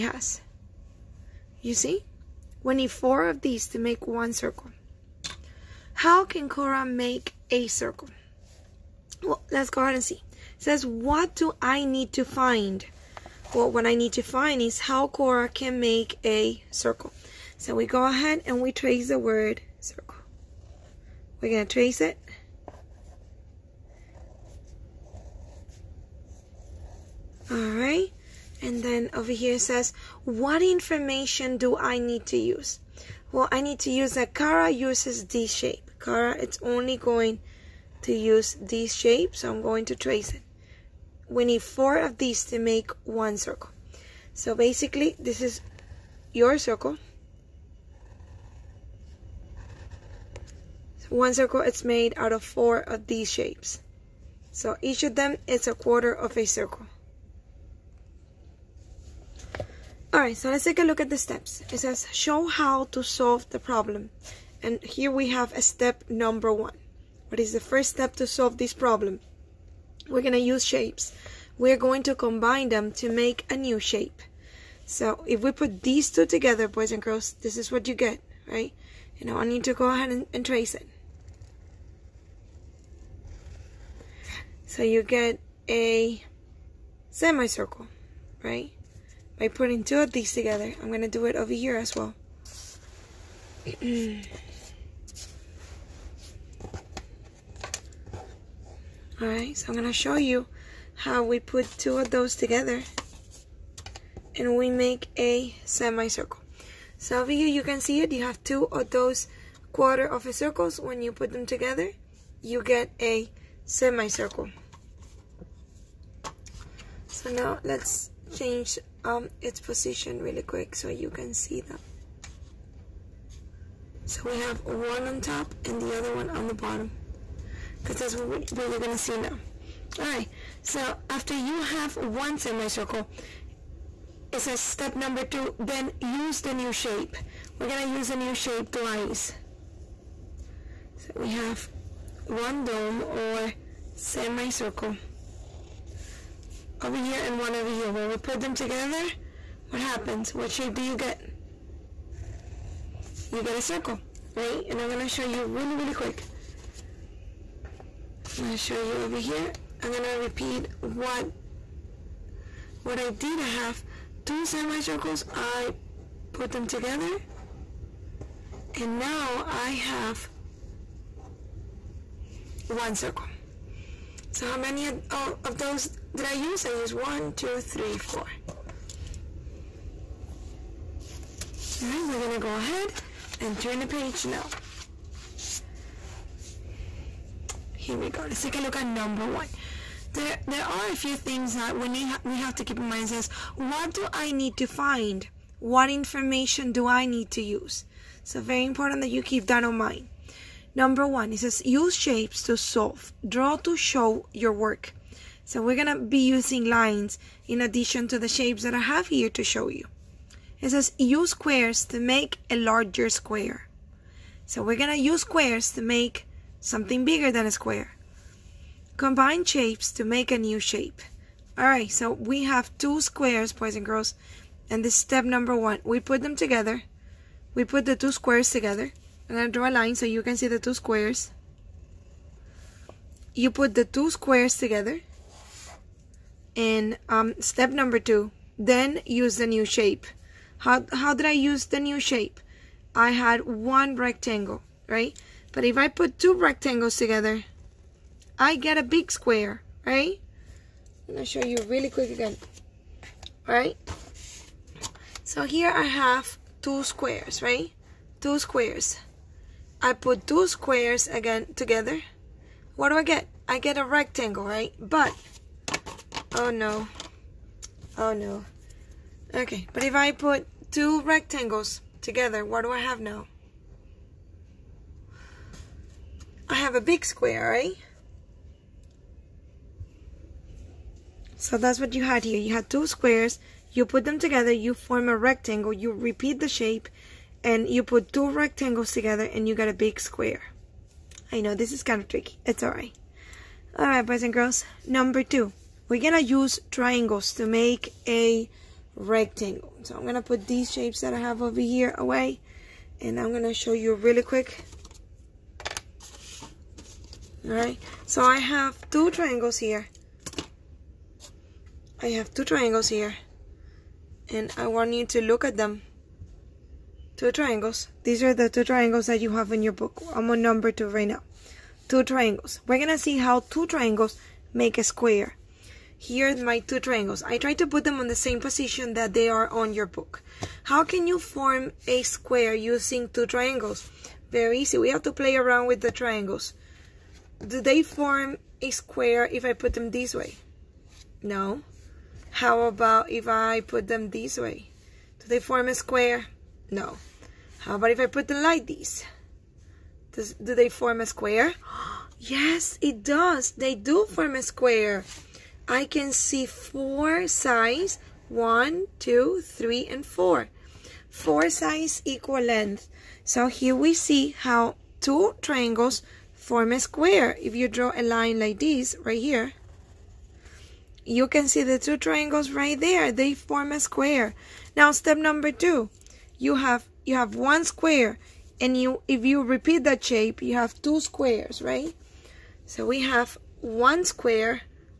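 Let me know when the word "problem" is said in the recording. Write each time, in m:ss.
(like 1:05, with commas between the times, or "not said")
1:03, 1:08.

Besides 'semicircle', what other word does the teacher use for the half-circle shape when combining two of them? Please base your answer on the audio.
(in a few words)
dome.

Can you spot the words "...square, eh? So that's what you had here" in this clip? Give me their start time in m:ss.
4:37.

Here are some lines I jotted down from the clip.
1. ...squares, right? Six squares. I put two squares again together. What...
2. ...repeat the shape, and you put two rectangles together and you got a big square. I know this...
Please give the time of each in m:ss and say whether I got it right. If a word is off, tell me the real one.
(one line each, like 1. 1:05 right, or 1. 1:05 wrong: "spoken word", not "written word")
1. 4:16 wrong: "Two", not "Six"
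2. 4:45 right.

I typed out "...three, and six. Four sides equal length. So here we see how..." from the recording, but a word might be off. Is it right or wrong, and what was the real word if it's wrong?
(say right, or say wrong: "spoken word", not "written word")
wrong: "four", not "six".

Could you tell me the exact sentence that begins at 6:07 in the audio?
If you draw a line like this right here, you can see the two triangles right there.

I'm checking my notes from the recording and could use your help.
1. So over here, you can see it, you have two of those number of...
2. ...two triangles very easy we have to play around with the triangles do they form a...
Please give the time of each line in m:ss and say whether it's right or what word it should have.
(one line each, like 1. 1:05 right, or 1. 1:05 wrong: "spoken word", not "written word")
1. 1:46 wrong: "quarter", not "number"
2. 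5:33 right.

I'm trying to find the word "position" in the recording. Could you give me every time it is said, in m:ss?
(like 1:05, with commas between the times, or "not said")
1:59, 5:28.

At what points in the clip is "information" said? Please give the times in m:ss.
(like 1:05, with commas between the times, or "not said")
0:30, 3:15.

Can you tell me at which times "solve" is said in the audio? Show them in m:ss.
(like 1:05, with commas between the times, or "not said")
1:03, 1:08, 3:22.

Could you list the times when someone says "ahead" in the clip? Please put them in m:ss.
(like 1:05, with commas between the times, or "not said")
0:09, 0:18, 1:19, 3:02.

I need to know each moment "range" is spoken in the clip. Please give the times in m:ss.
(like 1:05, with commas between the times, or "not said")
not said.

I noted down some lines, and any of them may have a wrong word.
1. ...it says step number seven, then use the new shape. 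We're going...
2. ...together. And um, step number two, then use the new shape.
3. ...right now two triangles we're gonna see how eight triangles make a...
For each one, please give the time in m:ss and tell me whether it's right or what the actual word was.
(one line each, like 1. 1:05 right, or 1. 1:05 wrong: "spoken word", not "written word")
1. 2:14 wrong: "two", not "seven"
2. 3:54 right
3. 5:20 wrong: "two", not "eight".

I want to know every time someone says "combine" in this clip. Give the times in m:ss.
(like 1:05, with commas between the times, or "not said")
1:12, 3:38.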